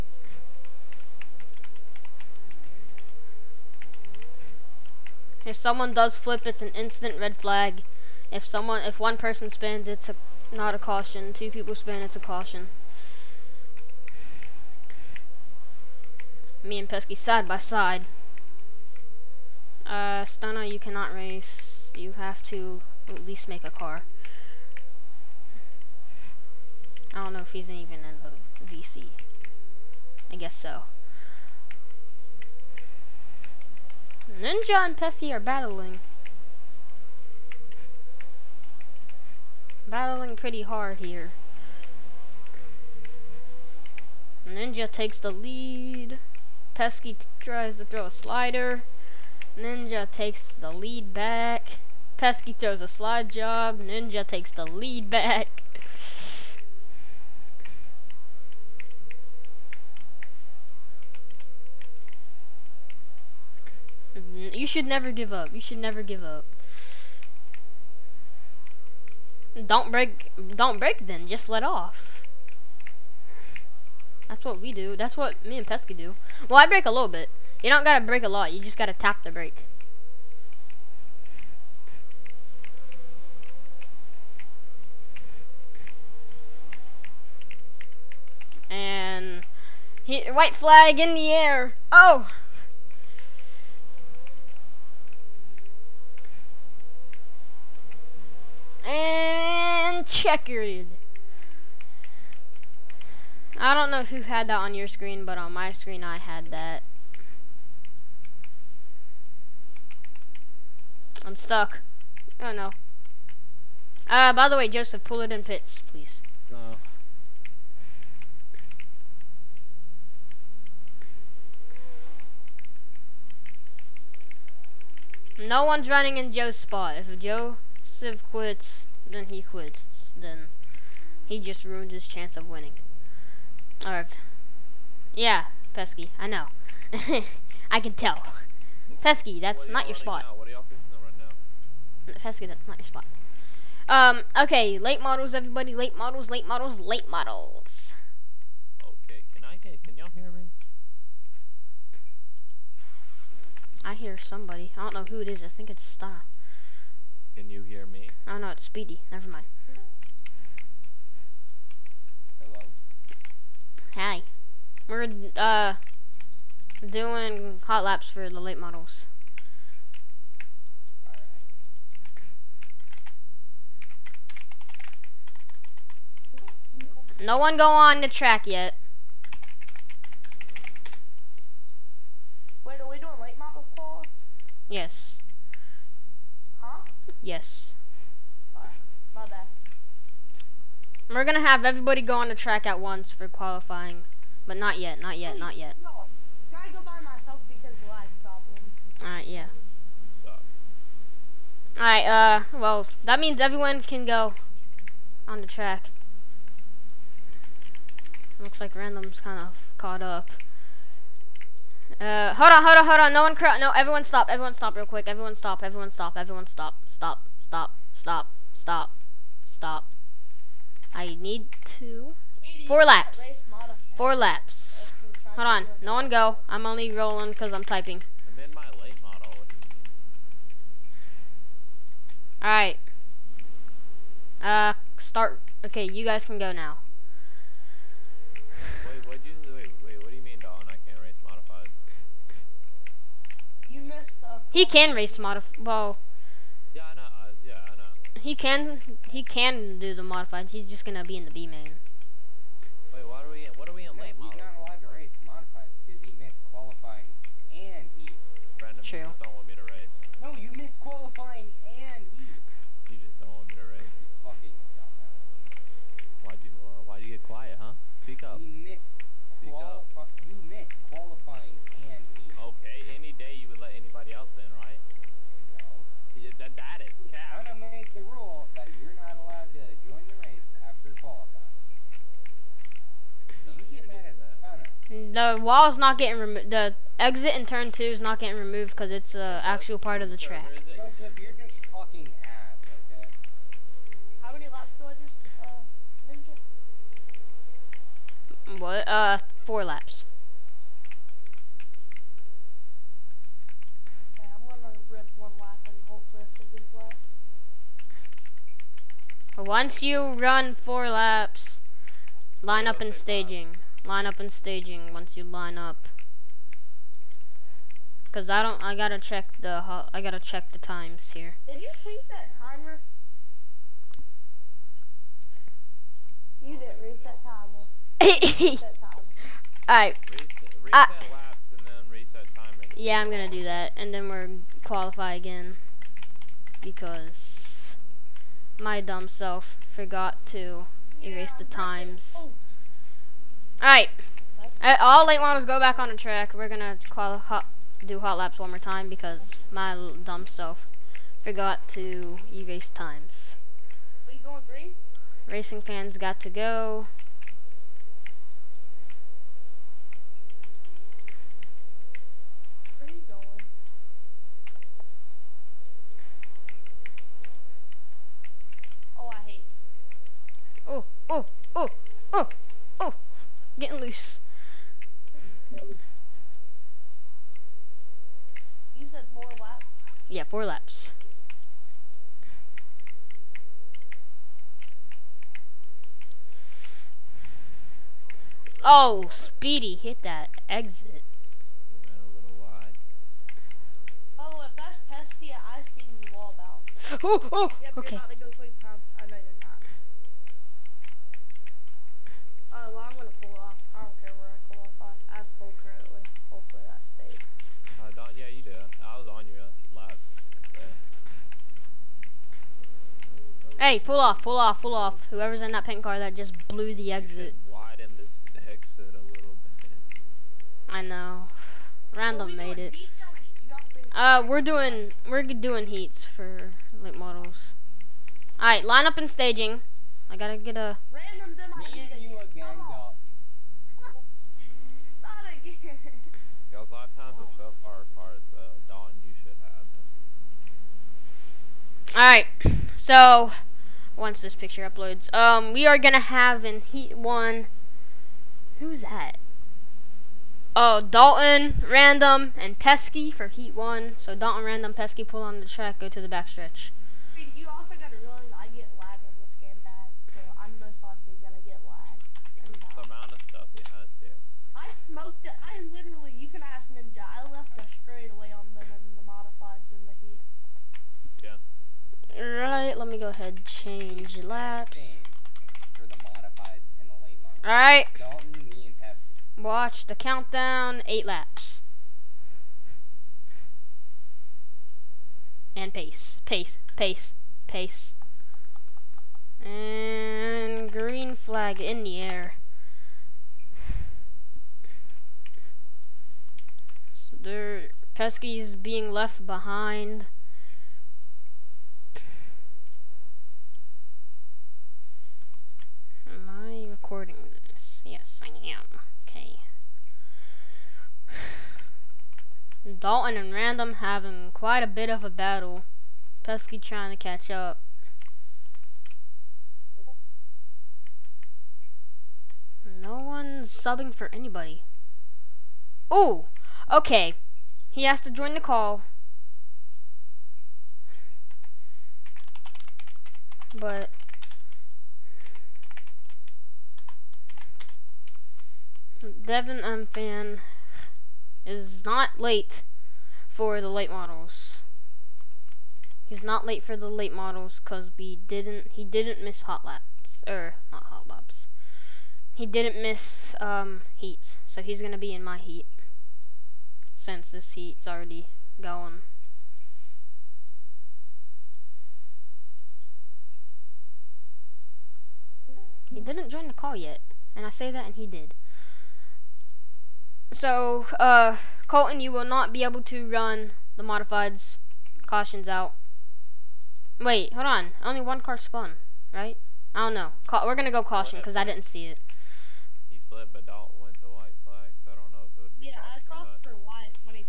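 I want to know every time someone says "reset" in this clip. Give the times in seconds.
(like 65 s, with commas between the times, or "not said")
321 s, 328 s.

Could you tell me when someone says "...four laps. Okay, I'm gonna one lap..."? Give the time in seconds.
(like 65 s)
299 s.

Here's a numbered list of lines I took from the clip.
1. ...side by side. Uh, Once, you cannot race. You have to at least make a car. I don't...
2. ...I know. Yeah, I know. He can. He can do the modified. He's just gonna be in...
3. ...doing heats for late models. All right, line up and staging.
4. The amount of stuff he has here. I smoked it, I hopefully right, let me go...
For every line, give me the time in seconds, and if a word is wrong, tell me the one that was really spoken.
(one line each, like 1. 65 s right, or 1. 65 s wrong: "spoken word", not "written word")
1. 17 s wrong: "Stunner", not "Once"
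2. 246 s right
3. 425 s right
4. 462 s wrong: "literally", not "hopefully".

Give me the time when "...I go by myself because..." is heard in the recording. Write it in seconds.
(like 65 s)
196 s.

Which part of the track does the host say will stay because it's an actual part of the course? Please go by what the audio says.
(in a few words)
exit in turn two.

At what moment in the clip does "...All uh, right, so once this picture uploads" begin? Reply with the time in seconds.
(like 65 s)
441 s.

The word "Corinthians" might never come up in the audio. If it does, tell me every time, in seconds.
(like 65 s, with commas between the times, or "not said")
not said.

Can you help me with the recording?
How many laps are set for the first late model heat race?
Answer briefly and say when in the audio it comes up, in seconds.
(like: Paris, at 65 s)
8, at 480 s.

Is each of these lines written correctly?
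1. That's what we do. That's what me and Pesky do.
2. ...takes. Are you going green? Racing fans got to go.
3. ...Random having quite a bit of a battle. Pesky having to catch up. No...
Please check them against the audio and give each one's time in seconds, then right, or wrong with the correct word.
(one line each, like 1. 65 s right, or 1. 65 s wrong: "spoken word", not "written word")
1. 74 s right
2. 352 s wrong: "times", not "takes"
3. 513 s wrong: "trying", not "having".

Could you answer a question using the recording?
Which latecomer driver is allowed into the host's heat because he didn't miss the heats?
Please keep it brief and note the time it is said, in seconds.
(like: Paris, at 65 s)
Devin M. Fan, at 539 s.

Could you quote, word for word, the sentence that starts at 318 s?
Cause I don't, I gotta check the, I gotta check the times here.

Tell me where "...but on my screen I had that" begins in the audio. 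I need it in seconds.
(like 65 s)
105 s.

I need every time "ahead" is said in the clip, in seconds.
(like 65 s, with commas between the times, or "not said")
473 s.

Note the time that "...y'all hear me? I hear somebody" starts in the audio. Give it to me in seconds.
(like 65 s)
149 s.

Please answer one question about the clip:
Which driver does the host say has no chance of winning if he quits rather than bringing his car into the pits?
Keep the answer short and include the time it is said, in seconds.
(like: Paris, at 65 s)
Joe Civ, at 127 s.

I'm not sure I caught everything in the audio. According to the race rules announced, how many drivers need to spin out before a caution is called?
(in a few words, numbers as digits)
2.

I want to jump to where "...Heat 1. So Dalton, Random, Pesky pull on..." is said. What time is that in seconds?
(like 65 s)
453 s.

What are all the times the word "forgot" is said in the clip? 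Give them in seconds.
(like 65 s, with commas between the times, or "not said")
339 s, 351 s.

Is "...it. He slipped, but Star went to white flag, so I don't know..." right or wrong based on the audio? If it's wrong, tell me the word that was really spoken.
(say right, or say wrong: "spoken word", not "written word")
wrong: "Dalton", not "Star".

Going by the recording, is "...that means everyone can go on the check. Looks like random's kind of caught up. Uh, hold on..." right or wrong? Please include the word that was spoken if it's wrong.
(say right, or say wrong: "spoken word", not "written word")
wrong: "track", not "check".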